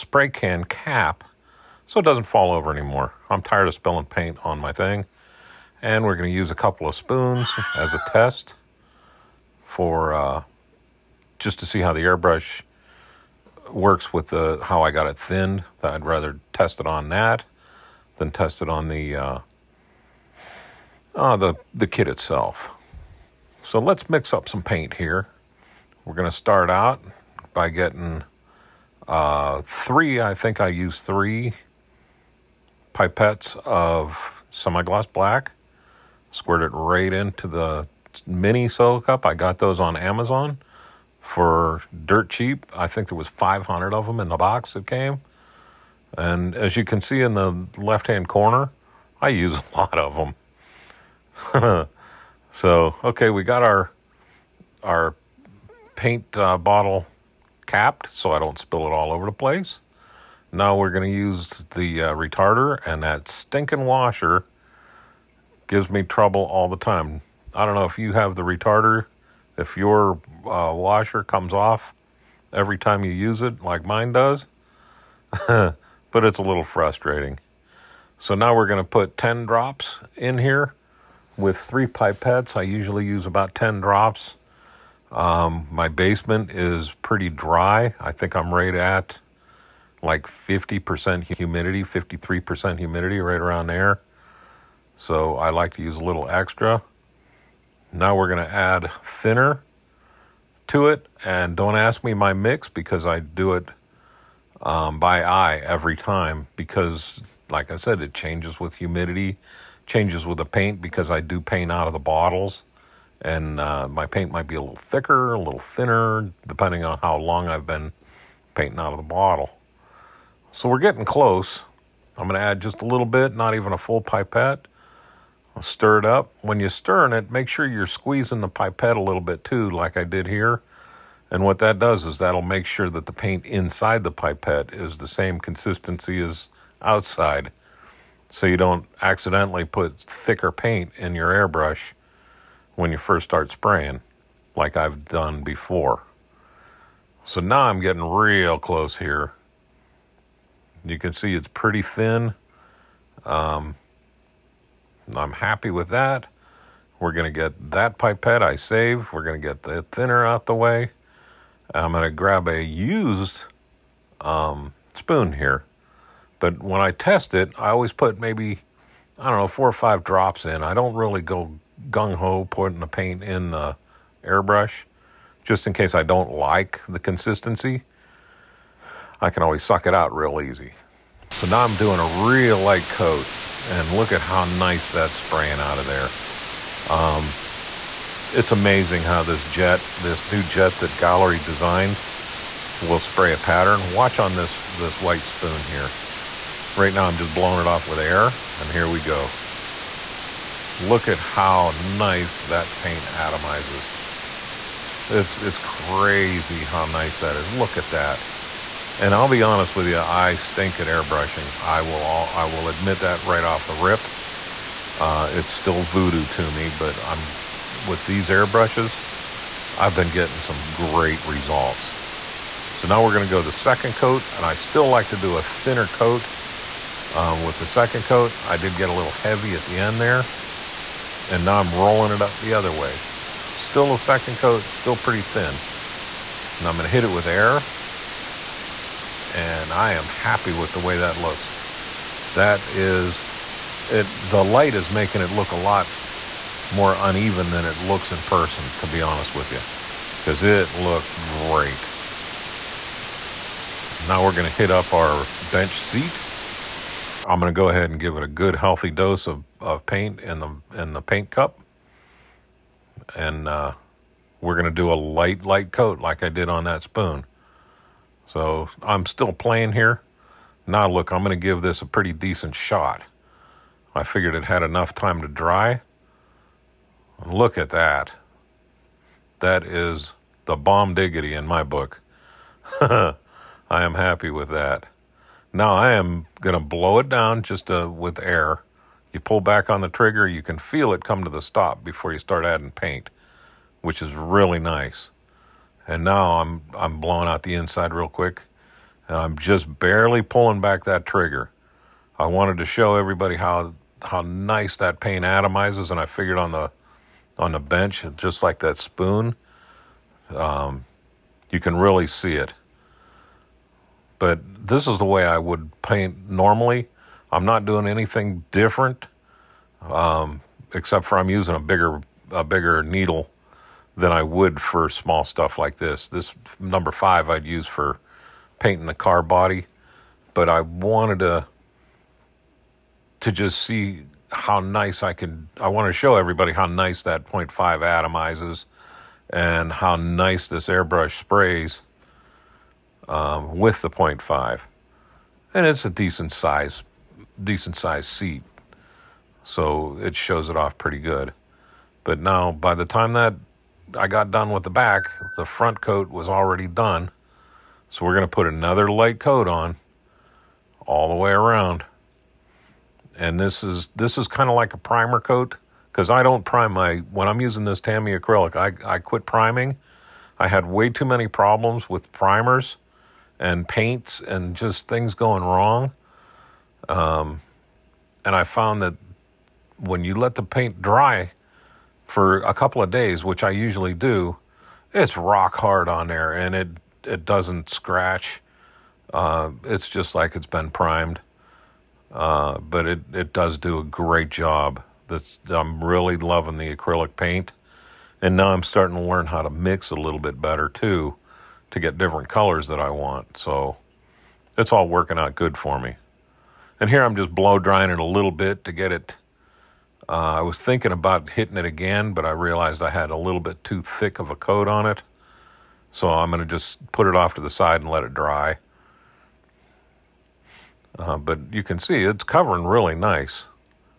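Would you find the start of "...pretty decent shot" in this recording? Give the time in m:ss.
4:31.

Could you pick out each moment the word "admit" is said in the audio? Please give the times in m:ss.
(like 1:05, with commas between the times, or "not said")
3:32.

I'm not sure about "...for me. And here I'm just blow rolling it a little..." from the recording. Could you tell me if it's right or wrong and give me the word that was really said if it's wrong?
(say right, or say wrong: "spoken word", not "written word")
wrong: "drying", not "rolling".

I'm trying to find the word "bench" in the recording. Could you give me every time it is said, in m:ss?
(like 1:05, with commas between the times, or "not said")
4:15, 5:07.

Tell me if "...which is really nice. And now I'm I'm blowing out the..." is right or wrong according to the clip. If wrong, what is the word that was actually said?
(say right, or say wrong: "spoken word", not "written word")
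right.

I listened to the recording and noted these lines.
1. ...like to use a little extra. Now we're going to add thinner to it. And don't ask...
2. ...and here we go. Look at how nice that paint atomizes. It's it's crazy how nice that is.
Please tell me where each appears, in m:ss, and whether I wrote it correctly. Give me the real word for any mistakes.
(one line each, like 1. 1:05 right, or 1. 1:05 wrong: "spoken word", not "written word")
1. 1:35 right
2. 3:18 right.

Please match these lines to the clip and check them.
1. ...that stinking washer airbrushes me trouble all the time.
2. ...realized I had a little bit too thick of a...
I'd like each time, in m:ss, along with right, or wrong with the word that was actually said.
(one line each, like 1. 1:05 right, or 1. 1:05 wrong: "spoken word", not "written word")
1. 1:03 wrong: "gives", not "airbrushes"
2. 6:52 right.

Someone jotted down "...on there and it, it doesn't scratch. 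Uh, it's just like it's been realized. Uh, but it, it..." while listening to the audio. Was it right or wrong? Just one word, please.
wrong.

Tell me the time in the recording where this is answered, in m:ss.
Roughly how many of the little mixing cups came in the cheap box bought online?
0:43.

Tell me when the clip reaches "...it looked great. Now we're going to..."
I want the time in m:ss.
4:10.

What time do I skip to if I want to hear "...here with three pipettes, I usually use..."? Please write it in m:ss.
1:20.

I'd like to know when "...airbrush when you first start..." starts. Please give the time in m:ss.
2:21.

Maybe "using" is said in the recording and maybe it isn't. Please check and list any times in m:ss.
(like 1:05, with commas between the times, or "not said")
5:21, 6:07.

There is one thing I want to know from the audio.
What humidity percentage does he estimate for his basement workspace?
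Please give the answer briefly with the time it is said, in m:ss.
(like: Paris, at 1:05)
53%, at 1:31.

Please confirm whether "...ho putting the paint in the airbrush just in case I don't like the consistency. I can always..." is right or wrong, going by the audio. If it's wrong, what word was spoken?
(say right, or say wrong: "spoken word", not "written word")
right.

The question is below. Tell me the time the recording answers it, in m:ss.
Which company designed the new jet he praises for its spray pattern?
3:10.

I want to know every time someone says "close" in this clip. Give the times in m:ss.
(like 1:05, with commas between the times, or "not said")
2:01, 2:28.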